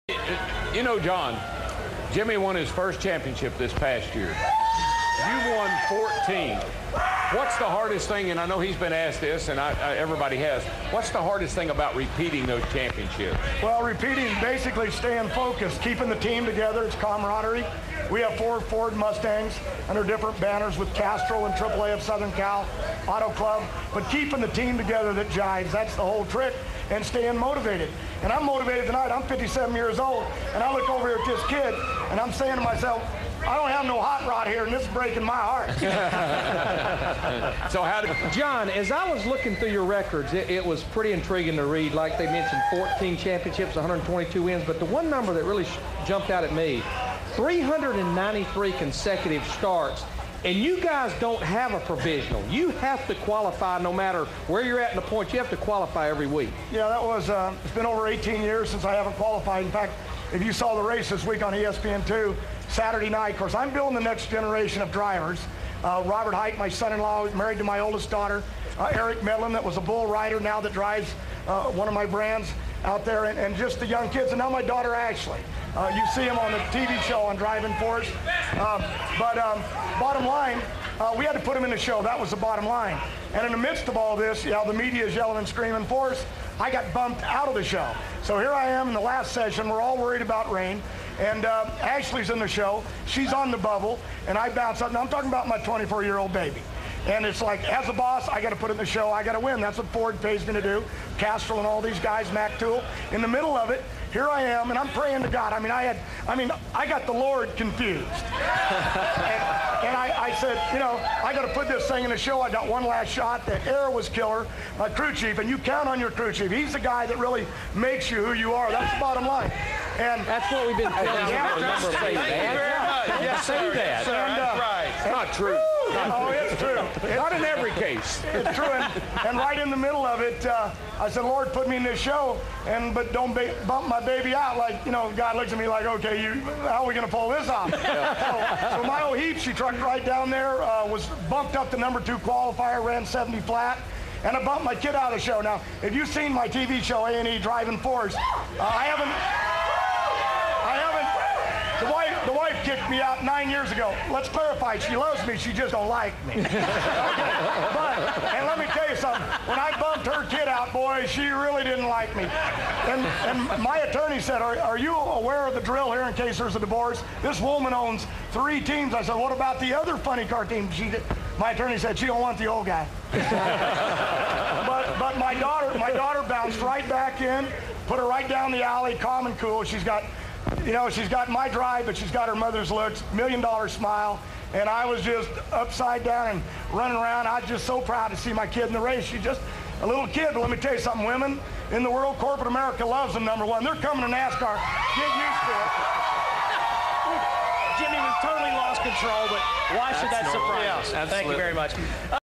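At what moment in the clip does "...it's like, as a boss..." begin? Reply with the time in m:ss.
1:37.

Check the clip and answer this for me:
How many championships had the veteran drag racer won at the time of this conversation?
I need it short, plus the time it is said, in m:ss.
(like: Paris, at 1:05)
14, at 0:05.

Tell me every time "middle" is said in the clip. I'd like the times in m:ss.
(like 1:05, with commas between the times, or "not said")
1:43, 2:09.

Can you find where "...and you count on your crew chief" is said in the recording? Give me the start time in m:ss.
1:55.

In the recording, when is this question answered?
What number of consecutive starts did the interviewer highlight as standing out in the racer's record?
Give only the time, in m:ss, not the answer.
0:47.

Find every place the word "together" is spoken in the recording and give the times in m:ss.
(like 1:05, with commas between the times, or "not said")
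0:16, 0:24.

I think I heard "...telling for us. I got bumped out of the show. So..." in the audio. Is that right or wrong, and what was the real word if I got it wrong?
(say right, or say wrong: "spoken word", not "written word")
wrong: "screaming", not "telling".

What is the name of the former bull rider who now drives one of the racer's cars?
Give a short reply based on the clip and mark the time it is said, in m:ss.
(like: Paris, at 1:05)
Eric Medlen, at 1:08.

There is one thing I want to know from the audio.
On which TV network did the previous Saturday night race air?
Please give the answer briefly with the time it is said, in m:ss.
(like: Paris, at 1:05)
ESPN2, at 1:01.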